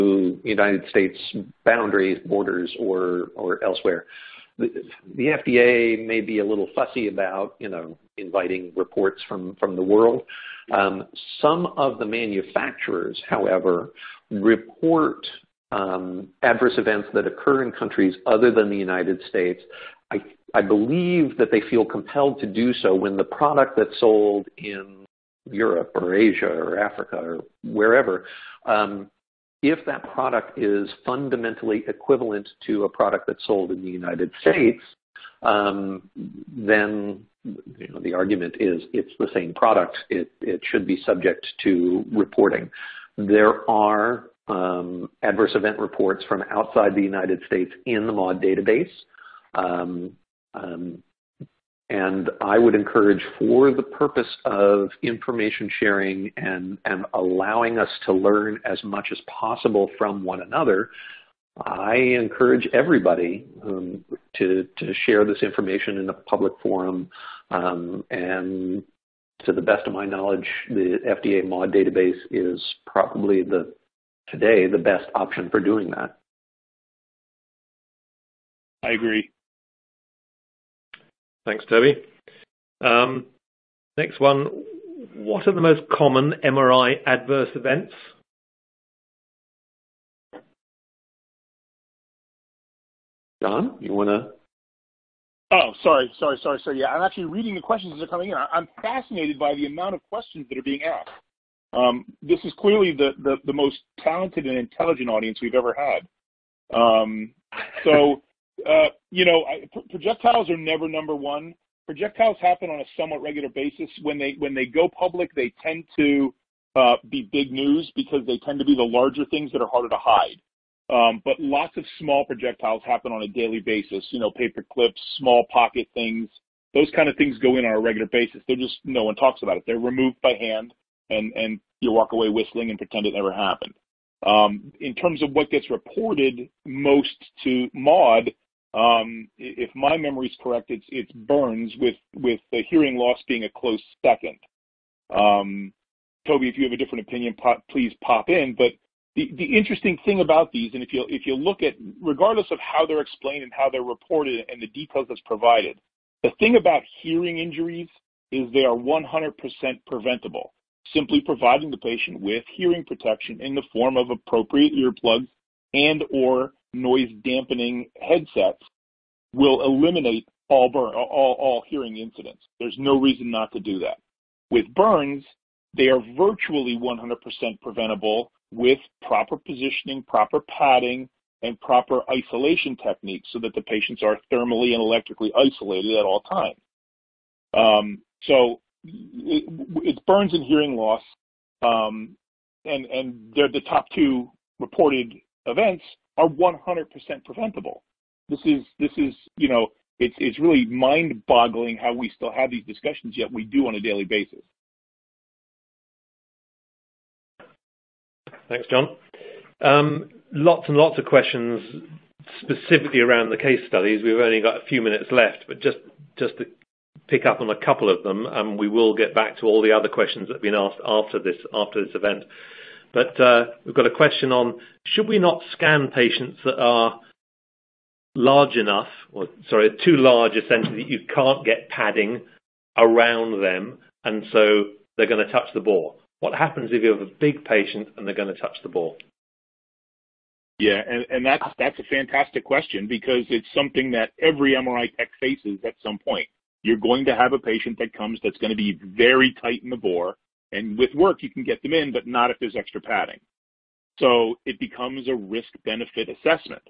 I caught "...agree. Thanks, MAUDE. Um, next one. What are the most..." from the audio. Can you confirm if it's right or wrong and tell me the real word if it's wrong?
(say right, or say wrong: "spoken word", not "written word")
wrong: "Toby", not "MAUDE".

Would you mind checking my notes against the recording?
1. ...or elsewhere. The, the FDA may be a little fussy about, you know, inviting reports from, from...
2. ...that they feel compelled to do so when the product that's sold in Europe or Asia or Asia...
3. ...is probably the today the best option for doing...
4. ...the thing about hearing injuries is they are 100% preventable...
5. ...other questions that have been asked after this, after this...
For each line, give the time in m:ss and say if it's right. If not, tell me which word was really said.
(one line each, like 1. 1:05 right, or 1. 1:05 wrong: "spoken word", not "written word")
1. 0:03 right
2. 0:21 wrong: "Africa", not "Asia"
3. 1:12 right
4. 2:36 right
5. 3:39 right.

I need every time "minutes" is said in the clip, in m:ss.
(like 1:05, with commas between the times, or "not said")
3:34.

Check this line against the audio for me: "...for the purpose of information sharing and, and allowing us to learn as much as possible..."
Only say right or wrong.
right.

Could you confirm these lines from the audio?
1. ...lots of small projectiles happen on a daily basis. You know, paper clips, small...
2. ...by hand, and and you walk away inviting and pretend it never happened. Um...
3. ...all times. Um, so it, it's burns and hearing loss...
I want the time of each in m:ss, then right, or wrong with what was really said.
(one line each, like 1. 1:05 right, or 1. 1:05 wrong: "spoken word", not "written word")
1. 2:01 right
2. 2:10 wrong: "whistling", not "inviting"
3. 3:06 right.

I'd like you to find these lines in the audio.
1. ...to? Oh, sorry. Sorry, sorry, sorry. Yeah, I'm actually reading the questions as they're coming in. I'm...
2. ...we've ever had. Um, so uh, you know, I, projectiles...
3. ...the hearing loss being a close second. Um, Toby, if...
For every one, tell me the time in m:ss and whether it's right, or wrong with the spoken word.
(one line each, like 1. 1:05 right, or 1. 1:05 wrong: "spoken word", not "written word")
1. 1:34 right
2. 1:45 right
3. 2:22 right.